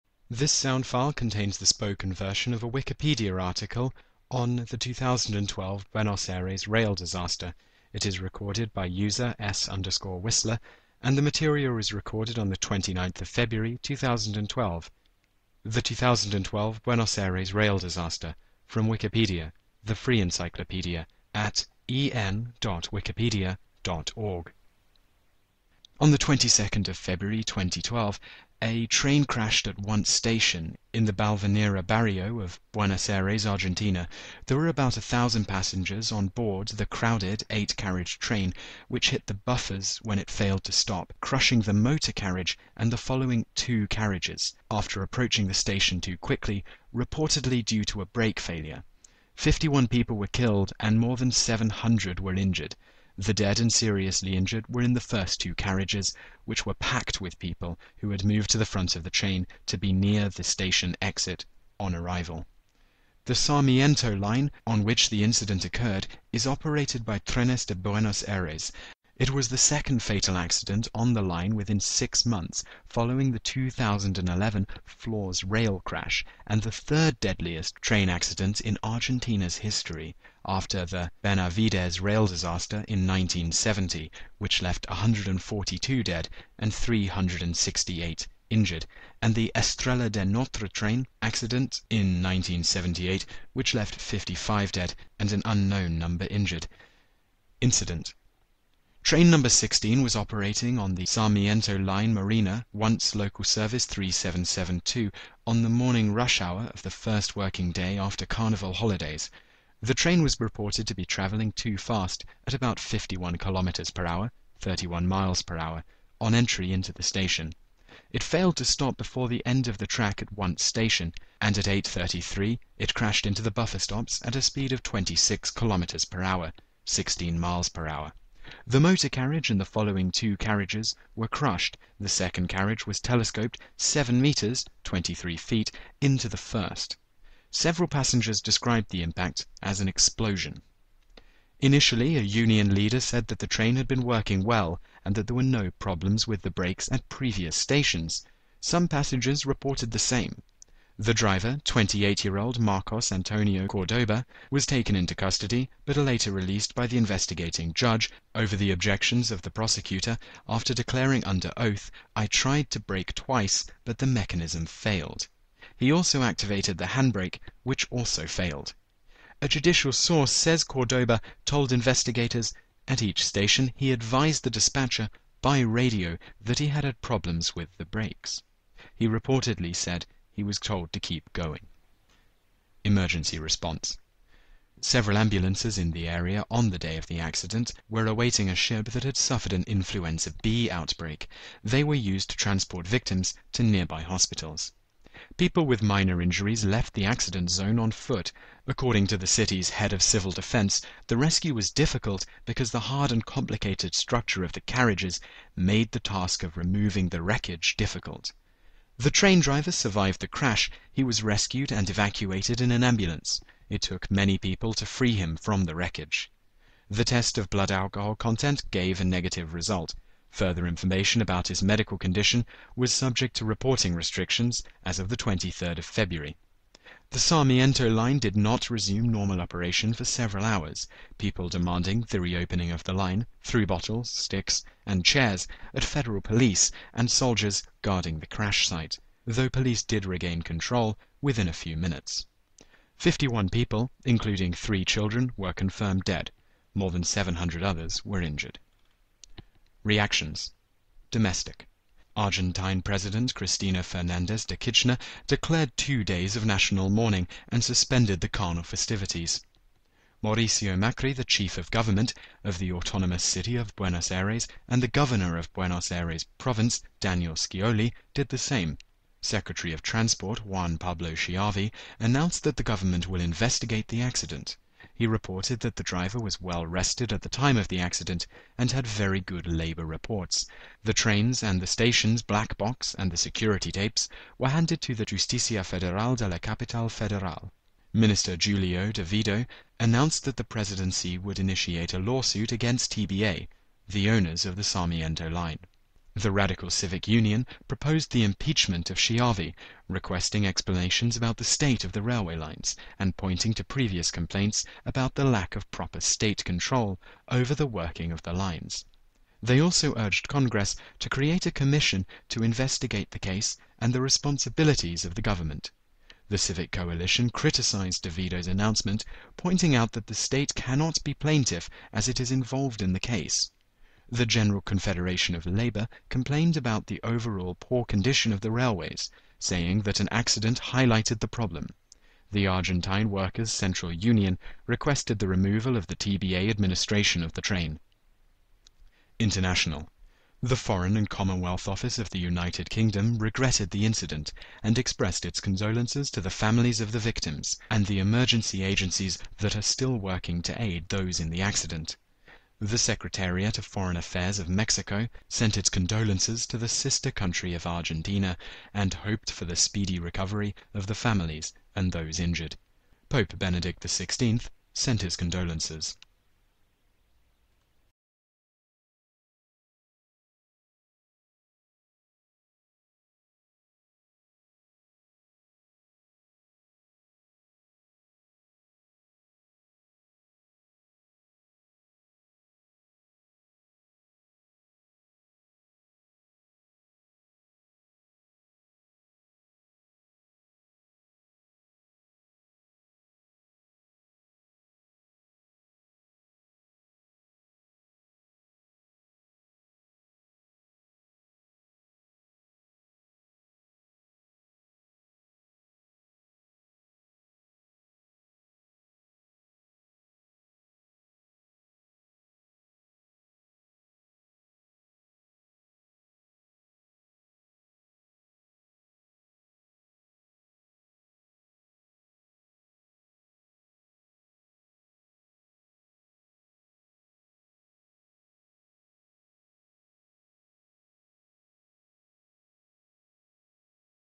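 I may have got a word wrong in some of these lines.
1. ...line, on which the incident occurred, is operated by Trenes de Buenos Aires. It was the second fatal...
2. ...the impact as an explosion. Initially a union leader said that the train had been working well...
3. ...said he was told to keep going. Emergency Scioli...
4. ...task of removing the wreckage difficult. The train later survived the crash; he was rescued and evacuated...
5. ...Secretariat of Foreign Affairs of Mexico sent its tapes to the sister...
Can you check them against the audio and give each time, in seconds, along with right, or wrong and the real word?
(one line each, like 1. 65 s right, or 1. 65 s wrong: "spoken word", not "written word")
1. 64 s right
2. 138 s right
3. 179 s wrong: "Response", not "Scioli"
4. 205 s wrong: "driver", not "later"
5. 352 s wrong: "condolences", not "tapes".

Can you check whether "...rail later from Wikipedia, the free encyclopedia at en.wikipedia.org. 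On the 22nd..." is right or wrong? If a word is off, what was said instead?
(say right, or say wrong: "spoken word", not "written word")
wrong: "disaster", not "later".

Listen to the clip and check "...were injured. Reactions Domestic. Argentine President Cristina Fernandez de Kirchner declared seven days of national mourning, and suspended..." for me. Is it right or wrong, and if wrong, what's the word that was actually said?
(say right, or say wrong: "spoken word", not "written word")
wrong: "two", not "seven".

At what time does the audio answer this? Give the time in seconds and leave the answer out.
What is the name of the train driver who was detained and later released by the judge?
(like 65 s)
152 s.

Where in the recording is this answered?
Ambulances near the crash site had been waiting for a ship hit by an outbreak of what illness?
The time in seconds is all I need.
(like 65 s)
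189 s.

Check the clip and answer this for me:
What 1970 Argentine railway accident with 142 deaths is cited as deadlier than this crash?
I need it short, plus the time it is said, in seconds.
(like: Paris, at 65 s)
Benavides rail disaster, at 81 s.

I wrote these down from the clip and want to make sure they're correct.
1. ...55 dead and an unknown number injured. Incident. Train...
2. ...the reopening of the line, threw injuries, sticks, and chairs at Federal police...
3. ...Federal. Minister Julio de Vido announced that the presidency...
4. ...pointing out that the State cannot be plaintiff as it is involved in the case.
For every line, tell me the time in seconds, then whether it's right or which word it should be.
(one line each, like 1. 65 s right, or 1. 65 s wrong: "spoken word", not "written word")
1. 94 s right
2. 232 s wrong: "bottles", not "injuries"
3. 286 s right
4. 319 s right.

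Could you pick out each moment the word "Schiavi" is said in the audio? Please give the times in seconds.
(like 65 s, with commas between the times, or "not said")
271 s, 298 s.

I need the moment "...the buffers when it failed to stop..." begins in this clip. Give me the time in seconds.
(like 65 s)
39 s.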